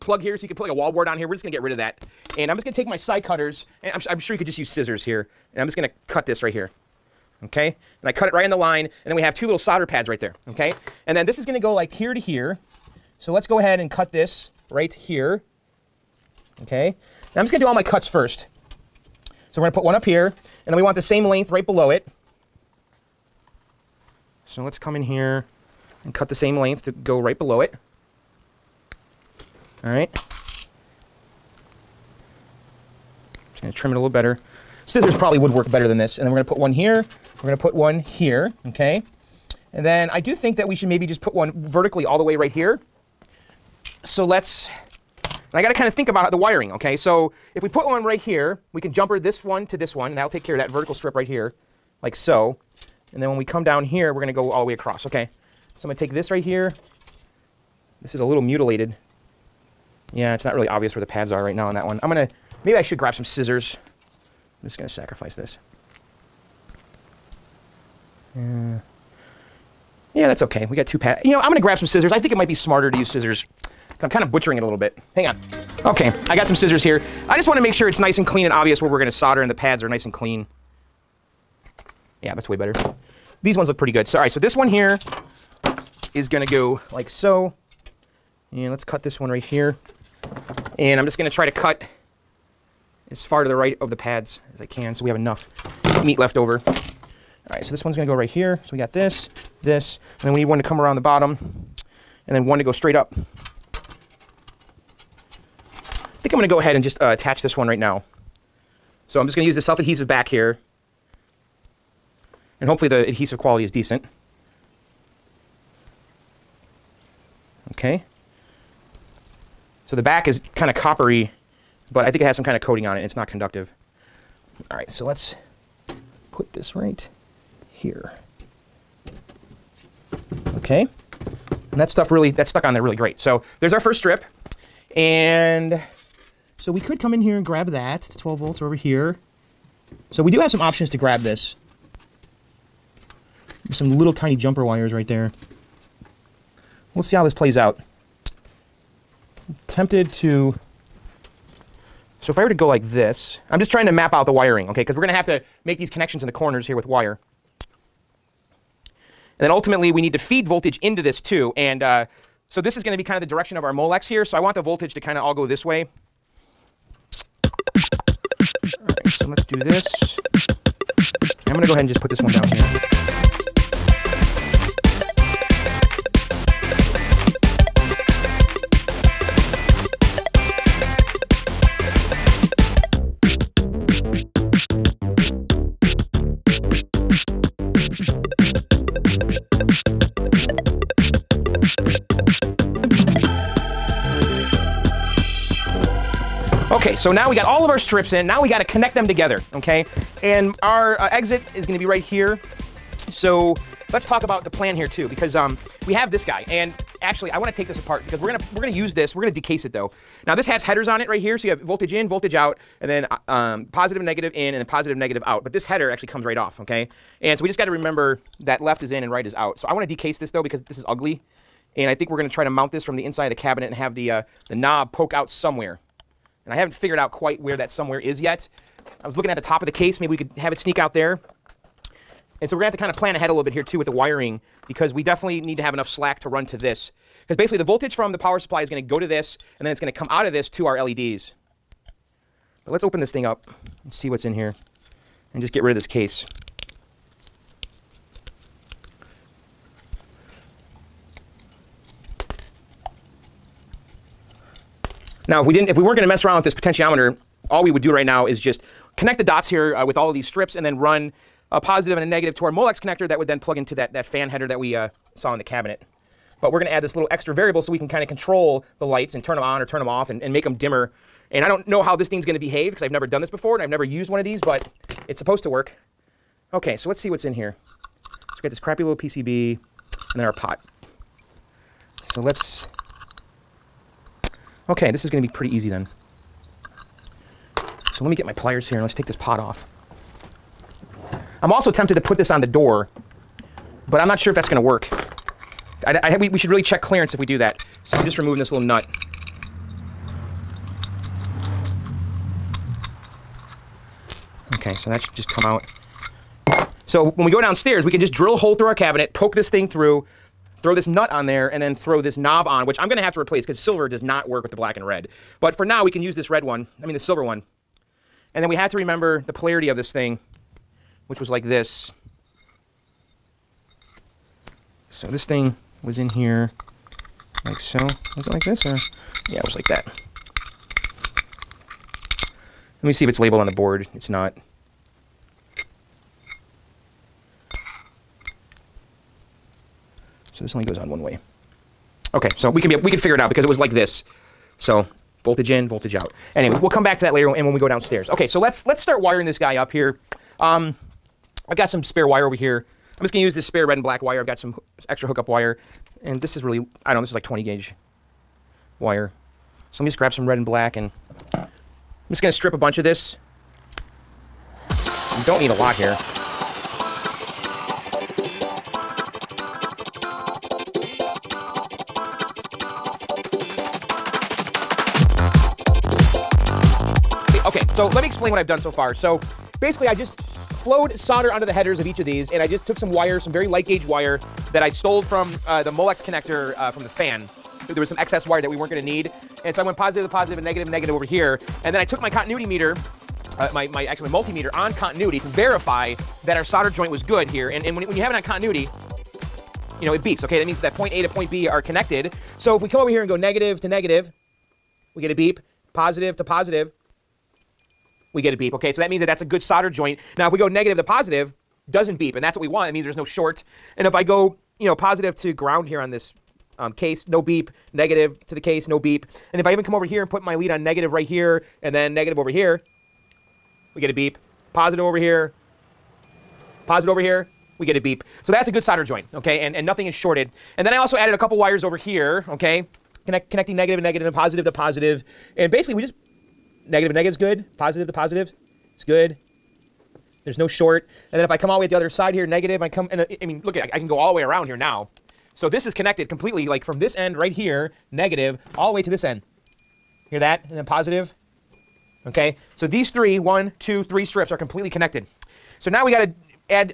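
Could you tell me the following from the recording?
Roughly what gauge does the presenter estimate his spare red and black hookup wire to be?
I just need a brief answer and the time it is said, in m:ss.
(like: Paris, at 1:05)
20 gauge, at 5:57.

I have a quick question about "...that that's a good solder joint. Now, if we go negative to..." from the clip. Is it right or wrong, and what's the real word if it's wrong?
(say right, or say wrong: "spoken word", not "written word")
right.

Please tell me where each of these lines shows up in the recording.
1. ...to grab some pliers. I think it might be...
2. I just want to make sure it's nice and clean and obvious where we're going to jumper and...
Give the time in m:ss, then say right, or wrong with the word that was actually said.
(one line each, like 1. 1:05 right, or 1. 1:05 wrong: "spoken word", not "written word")
1. 1:11 wrong: "scissors", not "pliers"
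2. 1:17 wrong: "solder", not "jumper".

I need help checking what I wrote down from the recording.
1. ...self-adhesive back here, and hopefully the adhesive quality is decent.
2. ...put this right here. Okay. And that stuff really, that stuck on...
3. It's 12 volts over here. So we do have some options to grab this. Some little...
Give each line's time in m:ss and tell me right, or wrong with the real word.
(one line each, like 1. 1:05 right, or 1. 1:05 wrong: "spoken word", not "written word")
1. 1:49 right
2. 2:06 right
3. 2:18 right.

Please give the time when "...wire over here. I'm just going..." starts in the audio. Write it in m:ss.
5:52.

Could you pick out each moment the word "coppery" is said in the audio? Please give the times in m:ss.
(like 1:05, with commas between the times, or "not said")
2:00.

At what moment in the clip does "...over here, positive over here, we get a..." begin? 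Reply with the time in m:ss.
7:04.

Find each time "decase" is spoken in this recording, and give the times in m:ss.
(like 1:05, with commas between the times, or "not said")
3:29, 3:39.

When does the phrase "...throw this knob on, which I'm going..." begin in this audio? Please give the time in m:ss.
5:11.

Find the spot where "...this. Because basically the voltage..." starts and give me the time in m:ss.
3:56.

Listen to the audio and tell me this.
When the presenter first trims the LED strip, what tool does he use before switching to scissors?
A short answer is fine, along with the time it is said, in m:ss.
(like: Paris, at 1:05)
Side cutters, at 0:02.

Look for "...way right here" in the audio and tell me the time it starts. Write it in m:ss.
0:42.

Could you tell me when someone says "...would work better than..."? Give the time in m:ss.
0:35.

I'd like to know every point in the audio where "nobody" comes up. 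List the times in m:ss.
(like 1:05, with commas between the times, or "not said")
not said.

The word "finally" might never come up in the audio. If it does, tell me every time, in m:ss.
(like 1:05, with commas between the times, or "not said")
not said.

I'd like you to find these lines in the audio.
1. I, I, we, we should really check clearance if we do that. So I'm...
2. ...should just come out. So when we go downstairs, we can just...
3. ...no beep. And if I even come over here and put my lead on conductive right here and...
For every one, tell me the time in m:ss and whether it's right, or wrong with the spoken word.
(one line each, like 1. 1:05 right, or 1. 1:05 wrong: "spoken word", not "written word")
1. 4:55 right
2. 5:05 right
3. 6:58 wrong: "negative", not "conductive".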